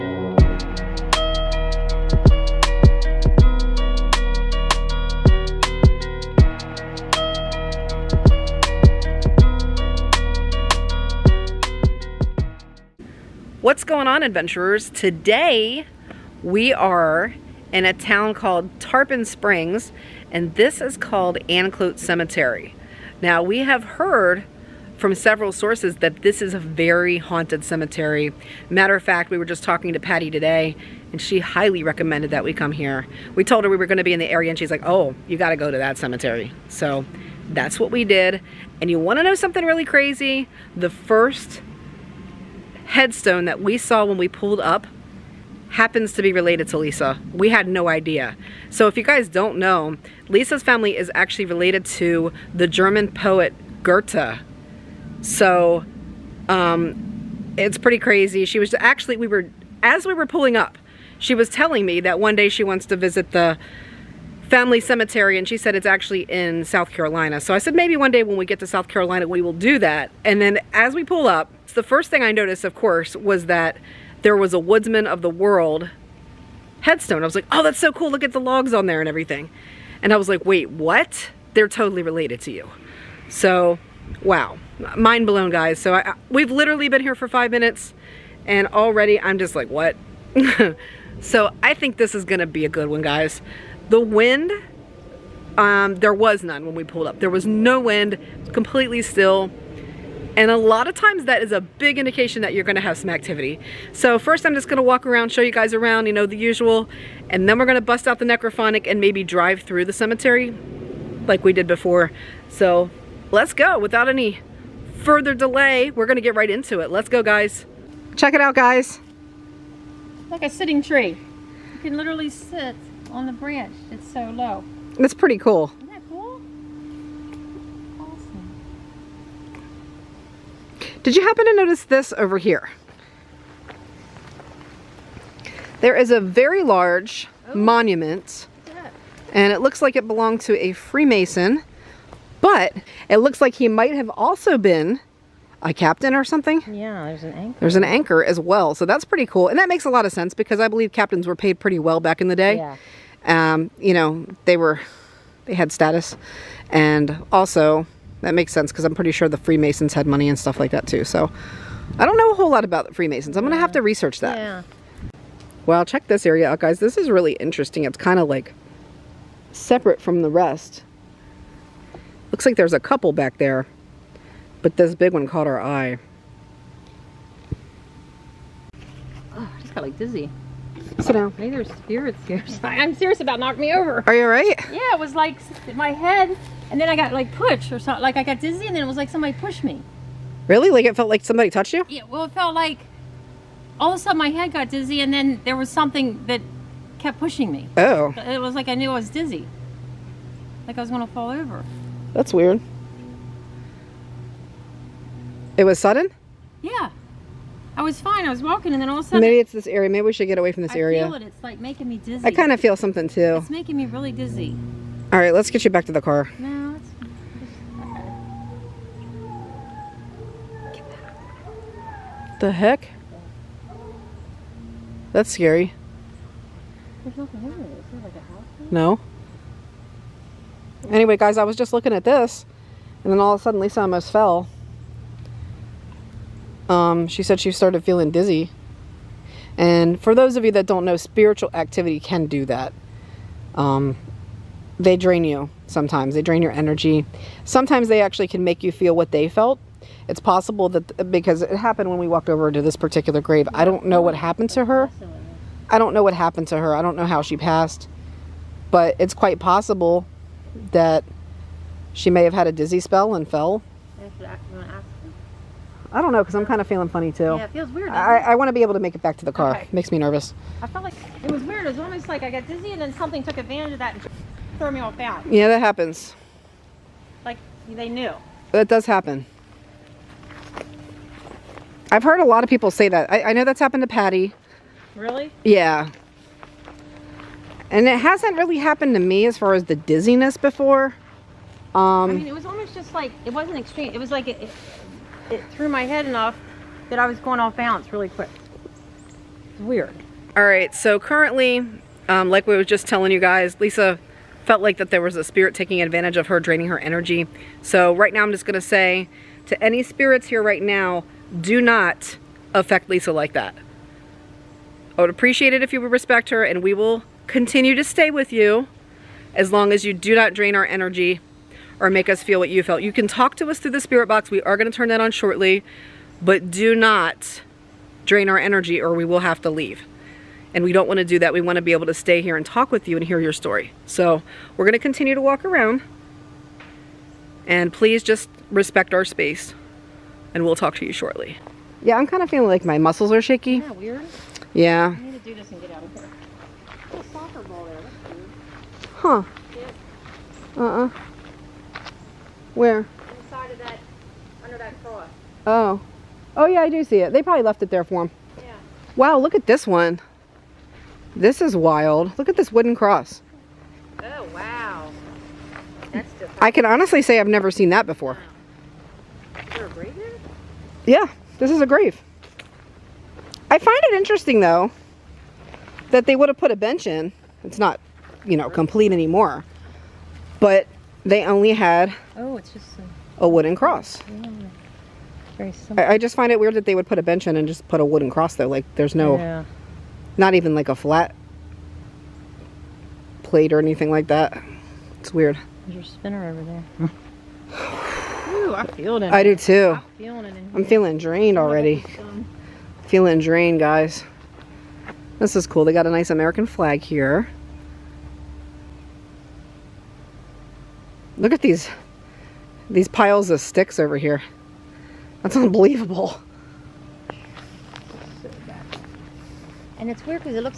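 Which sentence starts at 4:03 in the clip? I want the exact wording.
Um, they drain you sometimes, they drain your energy.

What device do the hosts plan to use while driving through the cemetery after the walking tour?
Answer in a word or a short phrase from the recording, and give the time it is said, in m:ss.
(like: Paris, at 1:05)
necrophonic, at 1:48.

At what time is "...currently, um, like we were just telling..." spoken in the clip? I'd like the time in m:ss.
5:00.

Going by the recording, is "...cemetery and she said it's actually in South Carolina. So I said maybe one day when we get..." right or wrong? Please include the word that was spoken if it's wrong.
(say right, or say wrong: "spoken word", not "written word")
right.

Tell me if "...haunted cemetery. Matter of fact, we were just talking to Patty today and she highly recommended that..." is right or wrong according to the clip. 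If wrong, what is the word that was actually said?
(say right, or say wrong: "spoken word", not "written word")
right.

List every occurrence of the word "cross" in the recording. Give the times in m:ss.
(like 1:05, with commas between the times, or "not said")
5:54, 6:02, 6:23, 6:28.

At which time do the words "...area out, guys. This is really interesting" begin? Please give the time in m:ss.
2:46.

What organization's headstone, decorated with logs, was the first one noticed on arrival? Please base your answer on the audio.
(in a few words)
Woodsman of the World.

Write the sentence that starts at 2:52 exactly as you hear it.
Looks like there's a couple back there, but this big one caught our eye.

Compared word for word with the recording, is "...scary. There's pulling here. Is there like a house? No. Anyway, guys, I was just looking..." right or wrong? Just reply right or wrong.
wrong.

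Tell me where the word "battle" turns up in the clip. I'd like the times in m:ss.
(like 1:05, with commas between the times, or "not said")
not said.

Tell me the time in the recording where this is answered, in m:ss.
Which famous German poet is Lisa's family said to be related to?
0:53.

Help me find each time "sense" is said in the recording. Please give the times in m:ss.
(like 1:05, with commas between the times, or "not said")
2:30, 2:38.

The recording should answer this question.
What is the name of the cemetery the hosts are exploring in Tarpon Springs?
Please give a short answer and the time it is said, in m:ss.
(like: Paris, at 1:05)
Anclote Cemetery, at 0:21.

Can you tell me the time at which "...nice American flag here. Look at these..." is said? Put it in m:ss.
6:45.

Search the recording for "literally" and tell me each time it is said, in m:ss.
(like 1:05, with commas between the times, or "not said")
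1:26, 2:01.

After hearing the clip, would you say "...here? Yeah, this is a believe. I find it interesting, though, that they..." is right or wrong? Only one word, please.
wrong.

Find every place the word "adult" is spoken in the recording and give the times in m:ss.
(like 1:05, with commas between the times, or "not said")
not said.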